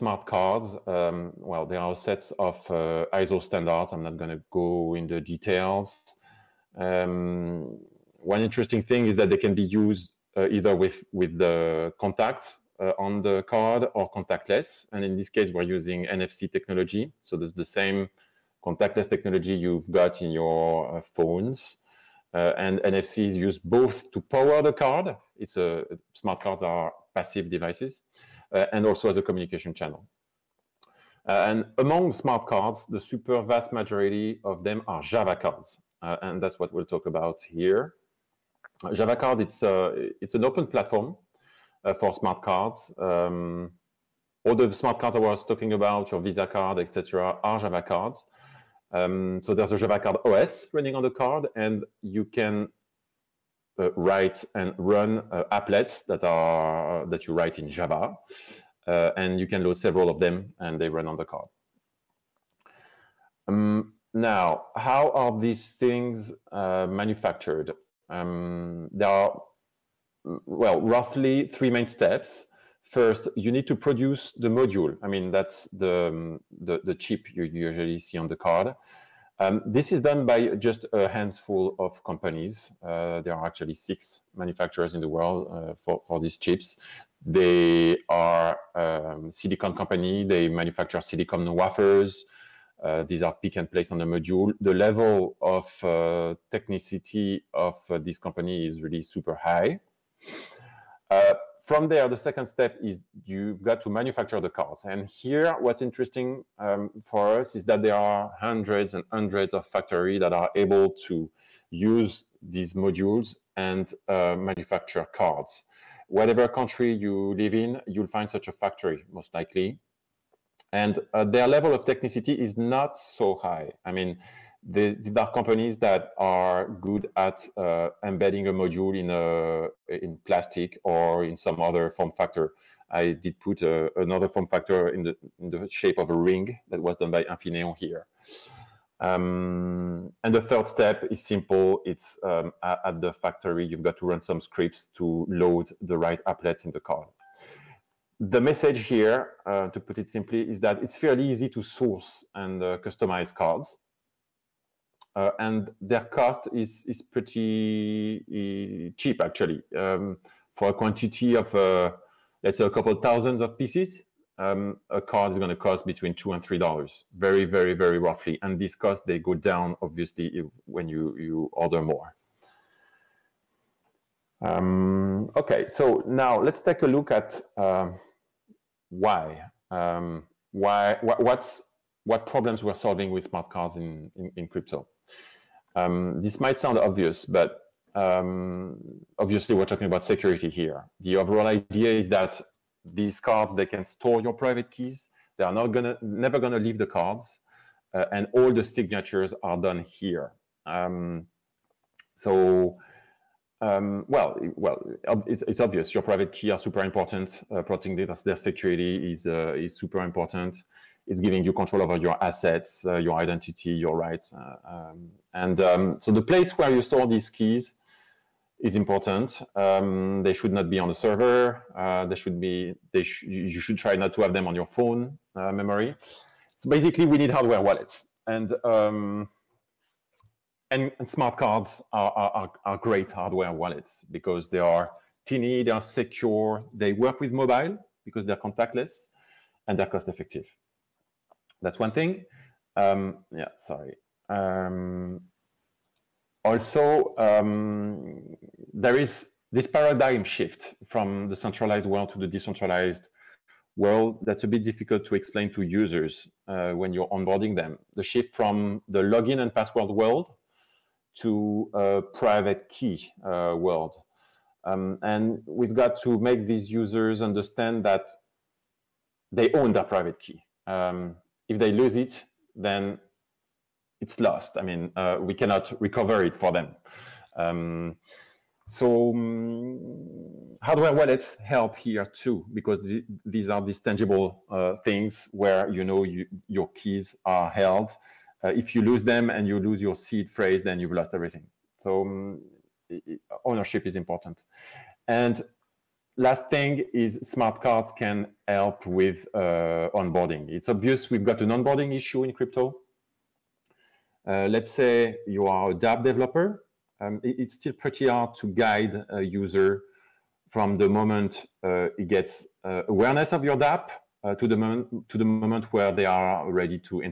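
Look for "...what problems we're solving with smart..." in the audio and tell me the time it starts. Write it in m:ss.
3:02.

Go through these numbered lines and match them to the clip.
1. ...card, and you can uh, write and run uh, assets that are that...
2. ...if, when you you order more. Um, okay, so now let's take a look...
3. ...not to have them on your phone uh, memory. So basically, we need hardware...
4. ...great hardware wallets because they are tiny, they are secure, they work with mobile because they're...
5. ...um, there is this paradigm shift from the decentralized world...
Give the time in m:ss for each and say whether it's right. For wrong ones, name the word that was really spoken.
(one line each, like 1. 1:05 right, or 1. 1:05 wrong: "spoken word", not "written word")
1. 0:51 wrong: "applets", not "assets"
2. 2:50 right
3. 3:43 right
4. 3:52 right
5. 4:07 wrong: "centralized", not "decentralized".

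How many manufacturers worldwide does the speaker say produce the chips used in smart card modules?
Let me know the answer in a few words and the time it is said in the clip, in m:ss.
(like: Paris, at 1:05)
6, at 1:23.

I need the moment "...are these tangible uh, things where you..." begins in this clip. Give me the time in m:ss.
4:43.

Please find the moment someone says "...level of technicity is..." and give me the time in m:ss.
2:01.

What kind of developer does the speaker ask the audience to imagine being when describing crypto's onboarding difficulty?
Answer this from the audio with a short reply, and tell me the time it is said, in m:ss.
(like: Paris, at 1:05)
dApp developer, at 5:05.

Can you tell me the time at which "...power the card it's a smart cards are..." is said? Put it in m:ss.
0:24.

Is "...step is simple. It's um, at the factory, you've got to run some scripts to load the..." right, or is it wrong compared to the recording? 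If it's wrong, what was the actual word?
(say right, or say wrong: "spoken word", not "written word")
right.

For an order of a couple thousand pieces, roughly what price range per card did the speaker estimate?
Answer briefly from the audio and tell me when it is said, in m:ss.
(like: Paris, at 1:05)
$2 to $3, at 2:45.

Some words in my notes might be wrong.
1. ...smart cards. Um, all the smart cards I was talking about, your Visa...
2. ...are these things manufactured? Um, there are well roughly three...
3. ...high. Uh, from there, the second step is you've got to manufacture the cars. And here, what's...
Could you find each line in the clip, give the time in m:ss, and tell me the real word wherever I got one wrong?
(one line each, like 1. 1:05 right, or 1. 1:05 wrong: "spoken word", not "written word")
1. 0:42 right
2. 1:05 right
3. 1:39 right.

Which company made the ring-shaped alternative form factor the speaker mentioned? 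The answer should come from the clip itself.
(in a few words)
Infineon.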